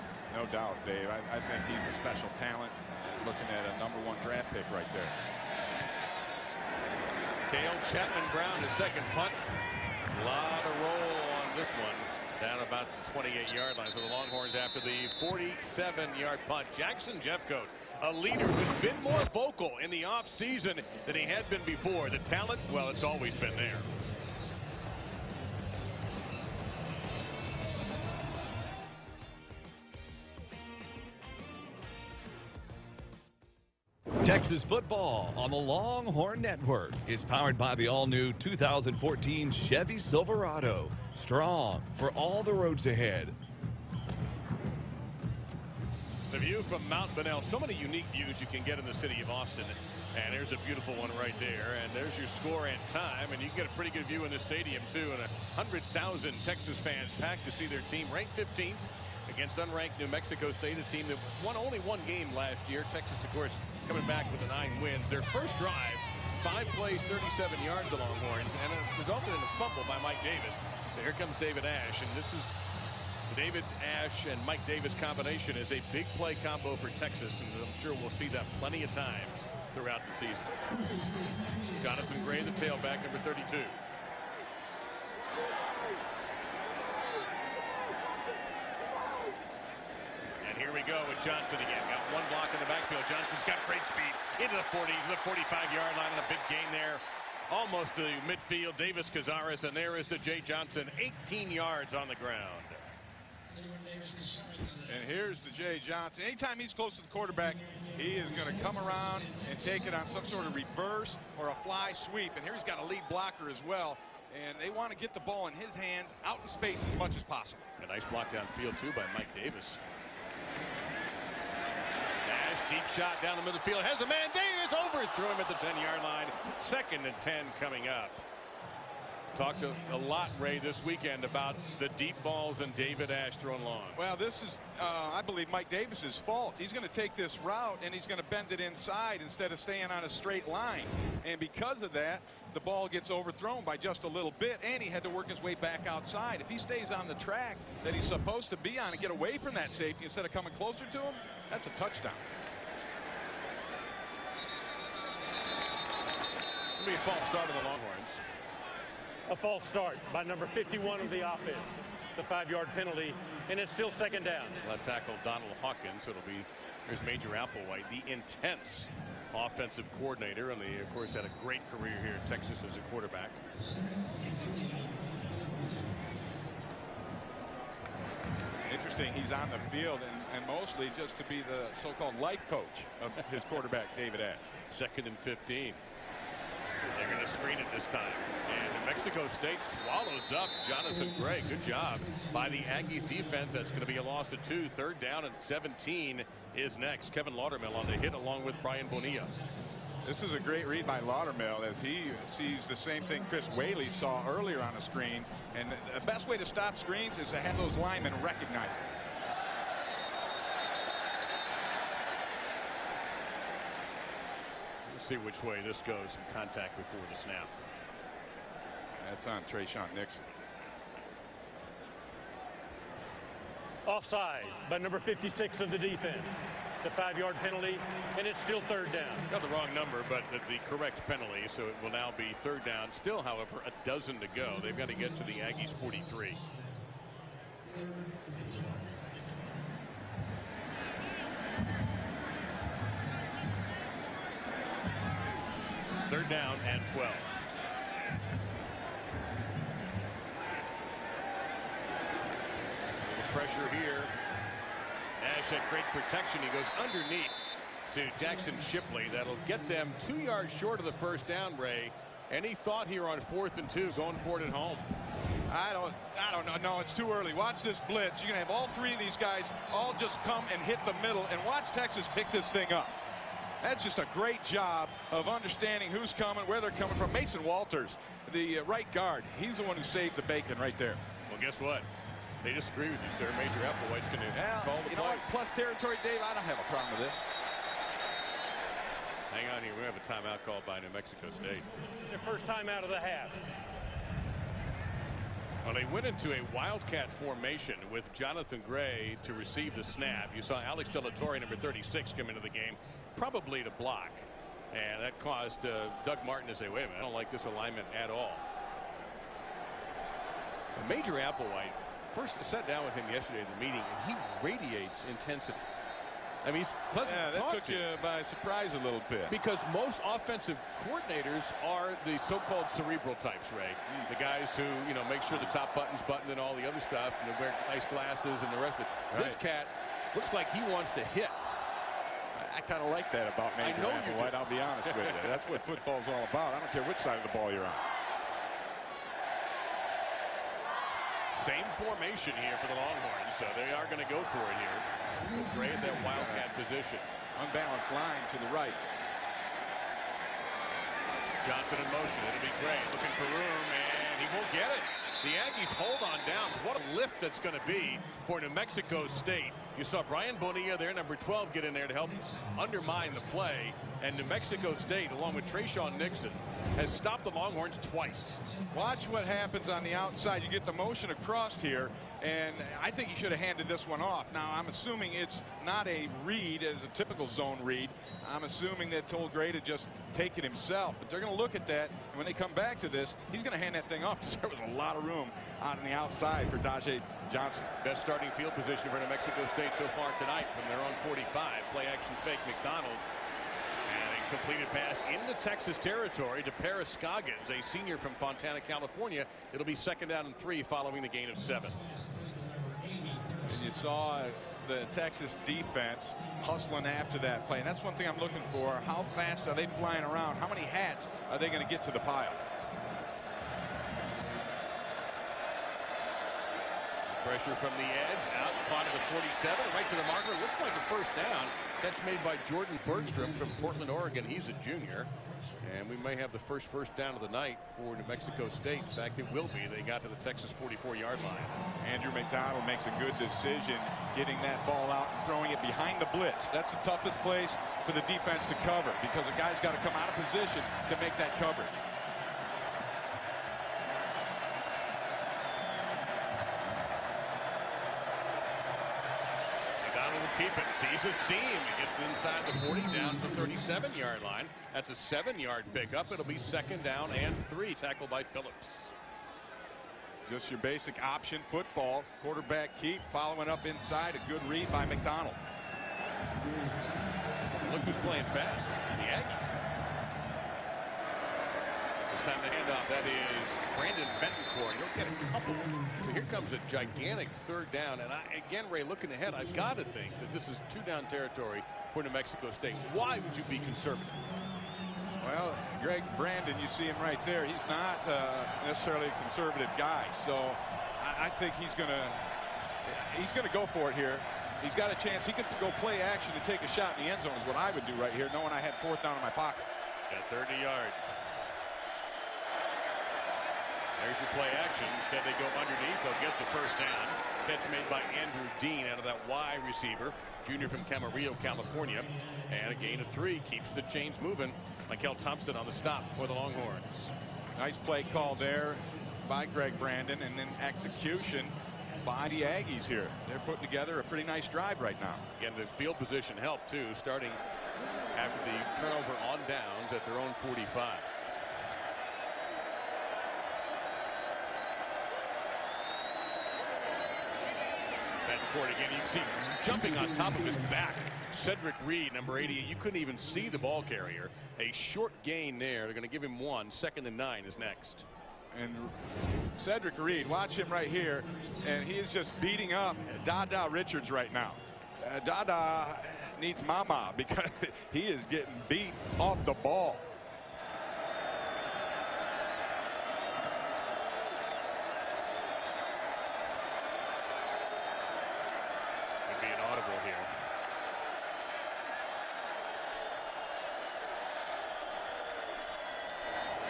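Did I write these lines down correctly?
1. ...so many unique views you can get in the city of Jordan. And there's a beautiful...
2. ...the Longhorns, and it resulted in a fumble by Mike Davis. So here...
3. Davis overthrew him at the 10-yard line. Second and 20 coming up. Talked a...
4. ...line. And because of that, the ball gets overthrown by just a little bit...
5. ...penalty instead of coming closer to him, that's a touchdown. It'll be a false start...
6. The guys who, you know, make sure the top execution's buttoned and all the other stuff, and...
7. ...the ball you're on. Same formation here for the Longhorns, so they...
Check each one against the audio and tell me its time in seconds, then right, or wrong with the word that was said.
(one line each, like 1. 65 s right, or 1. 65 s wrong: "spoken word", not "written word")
1. 47 s wrong: "Austin", not "Jordan"
2. 67 s right
3. 124 s wrong: "10", not "20"
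4. 140 s right
5. 149 s wrong: "safety", not "penalty"
6. 324 s wrong: "button", not "execution"
7. 337 s right.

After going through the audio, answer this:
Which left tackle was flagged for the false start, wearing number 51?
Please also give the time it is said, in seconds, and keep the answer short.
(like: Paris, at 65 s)
Donald Hawkins, at 165 s.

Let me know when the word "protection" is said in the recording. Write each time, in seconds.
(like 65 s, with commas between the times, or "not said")
255 s.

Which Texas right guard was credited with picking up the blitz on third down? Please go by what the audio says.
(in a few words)
Mason Walters.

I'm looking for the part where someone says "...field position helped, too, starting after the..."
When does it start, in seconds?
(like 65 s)
525 s.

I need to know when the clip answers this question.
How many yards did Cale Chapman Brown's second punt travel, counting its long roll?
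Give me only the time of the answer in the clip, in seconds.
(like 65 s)
15 s.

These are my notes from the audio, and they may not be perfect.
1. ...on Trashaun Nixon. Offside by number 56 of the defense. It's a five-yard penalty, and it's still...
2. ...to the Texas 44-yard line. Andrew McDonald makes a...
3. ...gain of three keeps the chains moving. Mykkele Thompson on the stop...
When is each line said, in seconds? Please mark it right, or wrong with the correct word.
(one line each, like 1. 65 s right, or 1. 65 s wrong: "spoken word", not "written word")
1. 219 s right
2. 430 s right
3. 512 s right.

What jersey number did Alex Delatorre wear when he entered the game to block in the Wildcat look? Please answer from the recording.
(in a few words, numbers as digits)
36.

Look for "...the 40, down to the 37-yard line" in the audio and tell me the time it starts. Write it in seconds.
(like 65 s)
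452 s.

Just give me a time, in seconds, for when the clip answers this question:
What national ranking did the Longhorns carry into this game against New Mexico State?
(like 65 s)
58 s.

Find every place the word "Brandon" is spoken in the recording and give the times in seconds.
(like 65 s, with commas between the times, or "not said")
473 s, 486 s, 519 s.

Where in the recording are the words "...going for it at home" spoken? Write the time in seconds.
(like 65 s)
263 s.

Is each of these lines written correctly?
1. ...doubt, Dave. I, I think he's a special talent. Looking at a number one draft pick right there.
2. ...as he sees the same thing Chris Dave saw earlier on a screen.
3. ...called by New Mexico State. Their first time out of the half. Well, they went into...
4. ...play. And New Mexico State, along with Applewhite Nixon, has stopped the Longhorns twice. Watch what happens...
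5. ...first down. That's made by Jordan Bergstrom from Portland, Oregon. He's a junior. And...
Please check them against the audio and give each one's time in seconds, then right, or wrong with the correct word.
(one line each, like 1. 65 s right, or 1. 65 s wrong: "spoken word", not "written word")
1. 0 s right
2. 201 s wrong: "Whaley", not "Dave"
3. 290 s right
4. 363 s wrong: "Trashaun", not "Applewhite"
5. 420 s right.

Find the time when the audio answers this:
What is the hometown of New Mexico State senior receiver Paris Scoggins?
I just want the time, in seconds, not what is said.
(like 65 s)
398 s.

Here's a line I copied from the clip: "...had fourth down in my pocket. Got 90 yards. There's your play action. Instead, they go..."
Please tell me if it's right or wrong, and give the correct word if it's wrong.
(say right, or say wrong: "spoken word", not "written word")
wrong: "30", not "90".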